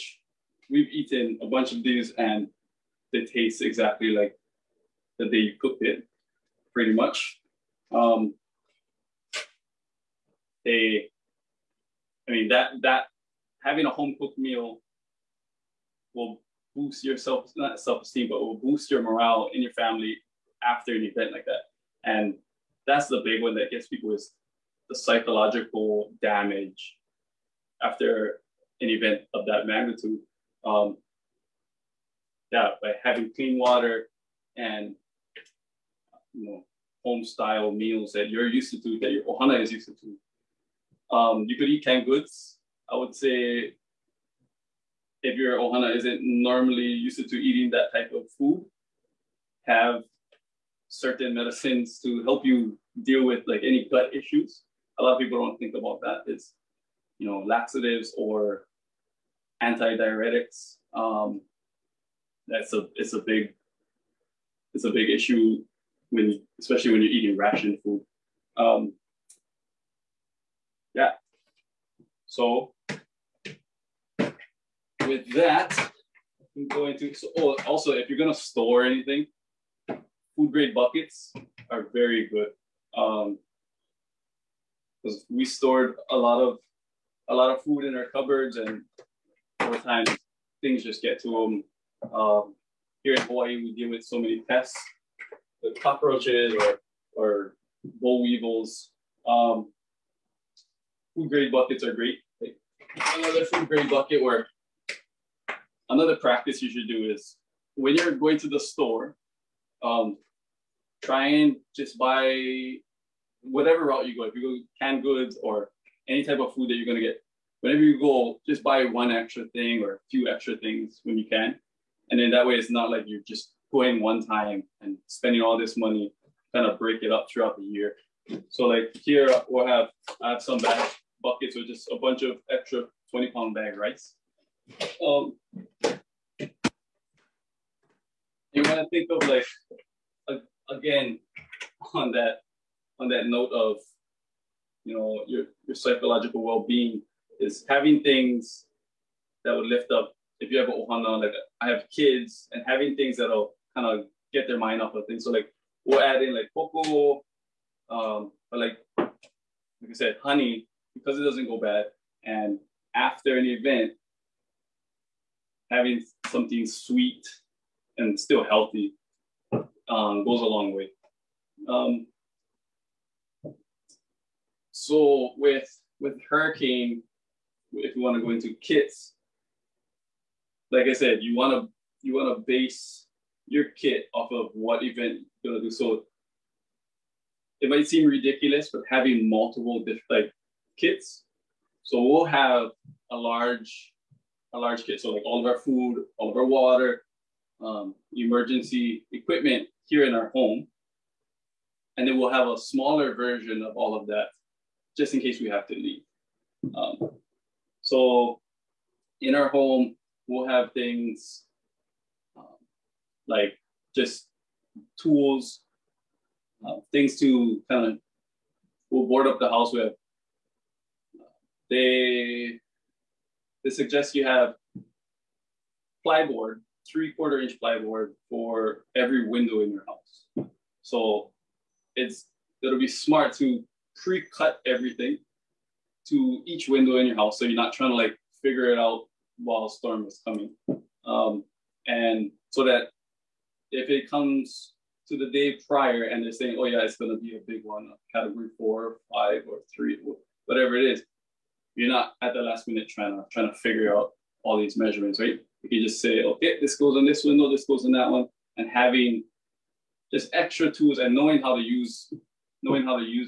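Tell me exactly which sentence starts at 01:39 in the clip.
Um, food grade buckets are great.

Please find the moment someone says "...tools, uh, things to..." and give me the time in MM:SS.
03:35.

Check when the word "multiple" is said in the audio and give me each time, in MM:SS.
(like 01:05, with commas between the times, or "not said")
03:09.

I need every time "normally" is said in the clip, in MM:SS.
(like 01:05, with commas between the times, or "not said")
00:46.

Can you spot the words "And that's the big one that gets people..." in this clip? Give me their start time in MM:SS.
00:22.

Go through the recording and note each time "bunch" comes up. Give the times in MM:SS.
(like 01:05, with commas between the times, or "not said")
00:01, 02:11.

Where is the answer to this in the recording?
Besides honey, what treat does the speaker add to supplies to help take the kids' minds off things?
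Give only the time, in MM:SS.
02:36.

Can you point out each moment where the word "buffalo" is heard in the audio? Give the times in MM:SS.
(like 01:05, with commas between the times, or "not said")
not said.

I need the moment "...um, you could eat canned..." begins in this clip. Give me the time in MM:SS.
00:41.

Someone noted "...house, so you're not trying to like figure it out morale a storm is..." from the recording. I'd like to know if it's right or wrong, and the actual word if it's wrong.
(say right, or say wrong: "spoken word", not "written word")
wrong: "while", not "morale".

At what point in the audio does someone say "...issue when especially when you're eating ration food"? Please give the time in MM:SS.
01:05.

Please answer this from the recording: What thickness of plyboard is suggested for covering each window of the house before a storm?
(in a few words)
3/4 inch.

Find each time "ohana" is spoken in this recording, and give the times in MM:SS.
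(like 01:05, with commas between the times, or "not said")
00:39, 00:45, 02:30.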